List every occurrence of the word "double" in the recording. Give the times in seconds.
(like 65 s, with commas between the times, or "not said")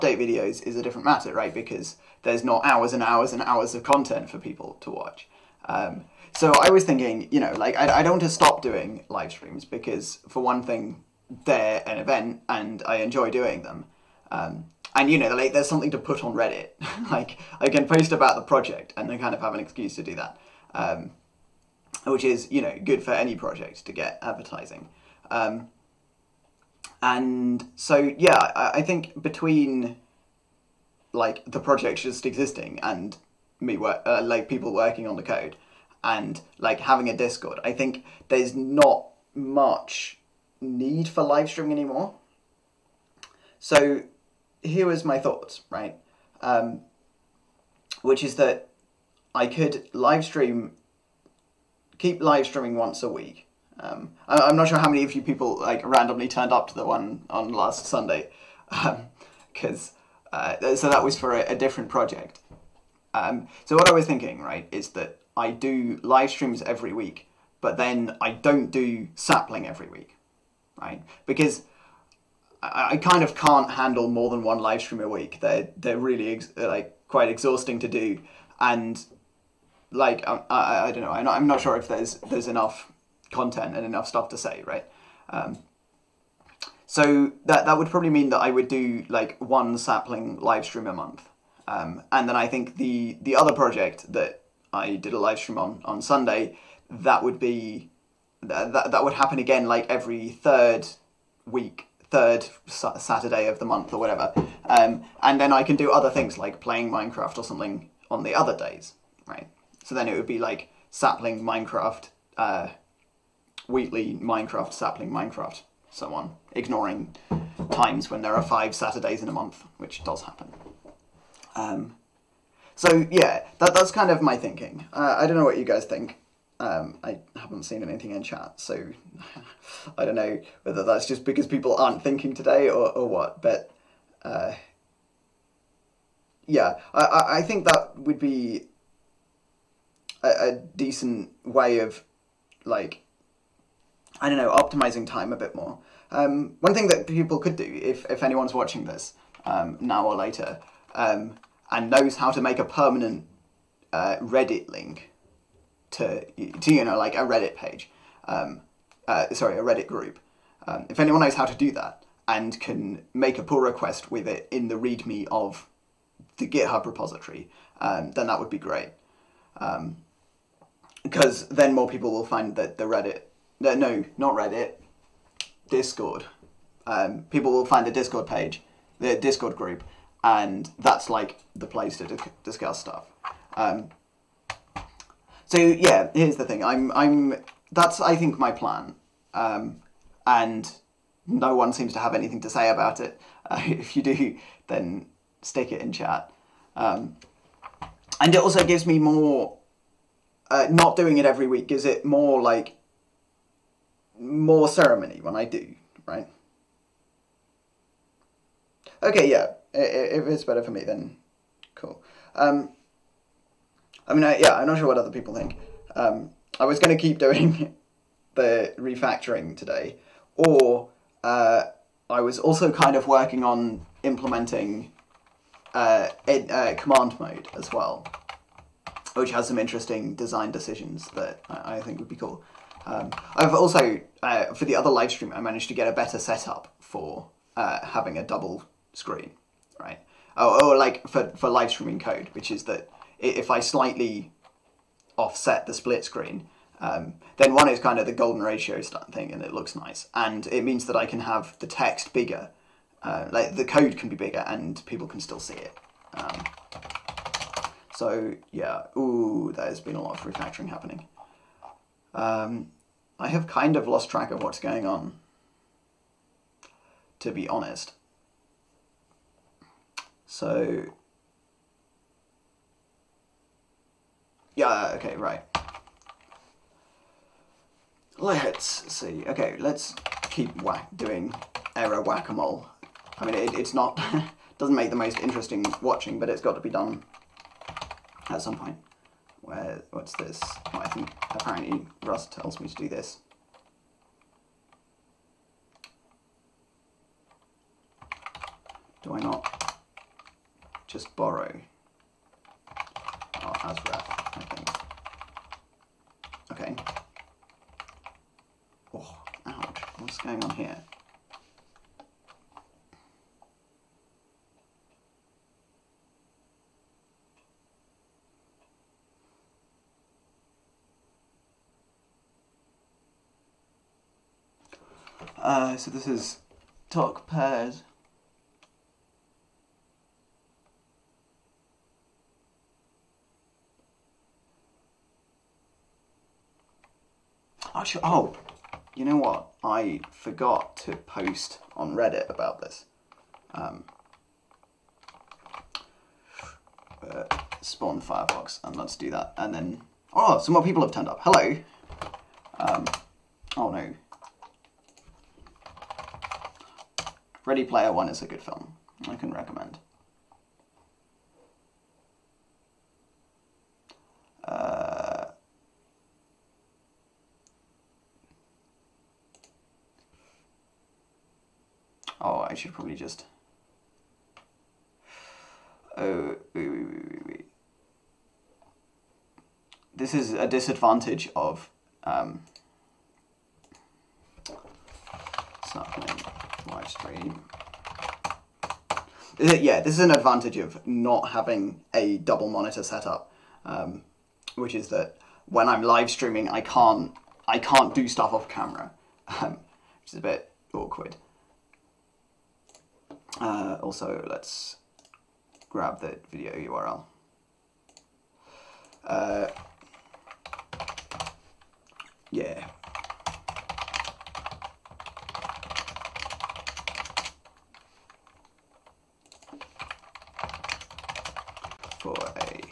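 238 s, 392 s.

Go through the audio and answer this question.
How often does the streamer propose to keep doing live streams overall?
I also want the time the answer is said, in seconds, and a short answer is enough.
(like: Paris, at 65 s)
once a week, at 52 s.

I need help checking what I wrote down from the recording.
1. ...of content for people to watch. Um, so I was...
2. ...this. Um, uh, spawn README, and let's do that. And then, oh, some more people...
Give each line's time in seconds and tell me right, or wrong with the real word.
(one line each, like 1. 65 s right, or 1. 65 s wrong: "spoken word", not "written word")
1. 3 s right
2. 342 s wrong: "Firefox", not "README".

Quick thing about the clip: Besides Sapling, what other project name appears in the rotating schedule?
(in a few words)
Wheatley.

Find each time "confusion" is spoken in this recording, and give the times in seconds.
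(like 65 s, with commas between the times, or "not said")
not said.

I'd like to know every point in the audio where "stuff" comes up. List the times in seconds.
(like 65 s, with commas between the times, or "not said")
84 s, 182 s, 398 s.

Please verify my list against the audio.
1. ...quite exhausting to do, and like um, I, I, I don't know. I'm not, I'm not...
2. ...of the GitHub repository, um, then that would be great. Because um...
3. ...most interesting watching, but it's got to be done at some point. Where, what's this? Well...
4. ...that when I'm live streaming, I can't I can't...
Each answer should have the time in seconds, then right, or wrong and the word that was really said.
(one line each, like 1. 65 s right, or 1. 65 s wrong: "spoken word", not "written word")
1. 77 s right
2. 165 s right
3. 284 s right
4. 394 s right.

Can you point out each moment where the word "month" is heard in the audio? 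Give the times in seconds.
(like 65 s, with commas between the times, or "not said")
90 s, 103 s, 119 s.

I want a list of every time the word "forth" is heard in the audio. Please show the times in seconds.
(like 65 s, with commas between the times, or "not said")
not said.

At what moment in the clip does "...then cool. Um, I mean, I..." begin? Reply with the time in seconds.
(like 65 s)
210 s.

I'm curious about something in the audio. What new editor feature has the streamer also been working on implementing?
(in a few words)
command mode.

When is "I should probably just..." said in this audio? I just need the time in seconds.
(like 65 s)
372 s.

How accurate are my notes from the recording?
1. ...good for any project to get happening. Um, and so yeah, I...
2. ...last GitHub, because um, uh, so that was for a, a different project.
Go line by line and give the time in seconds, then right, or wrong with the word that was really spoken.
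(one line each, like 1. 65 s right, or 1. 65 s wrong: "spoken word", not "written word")
1. 22 s wrong: "advertising", not "happening"
2. 57 s wrong: "Sunday", not "GitHub".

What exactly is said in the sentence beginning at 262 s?
Um, I have kind of lost track of what's going on, to be honest.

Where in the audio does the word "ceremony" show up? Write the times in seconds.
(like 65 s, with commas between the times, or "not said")
204 s.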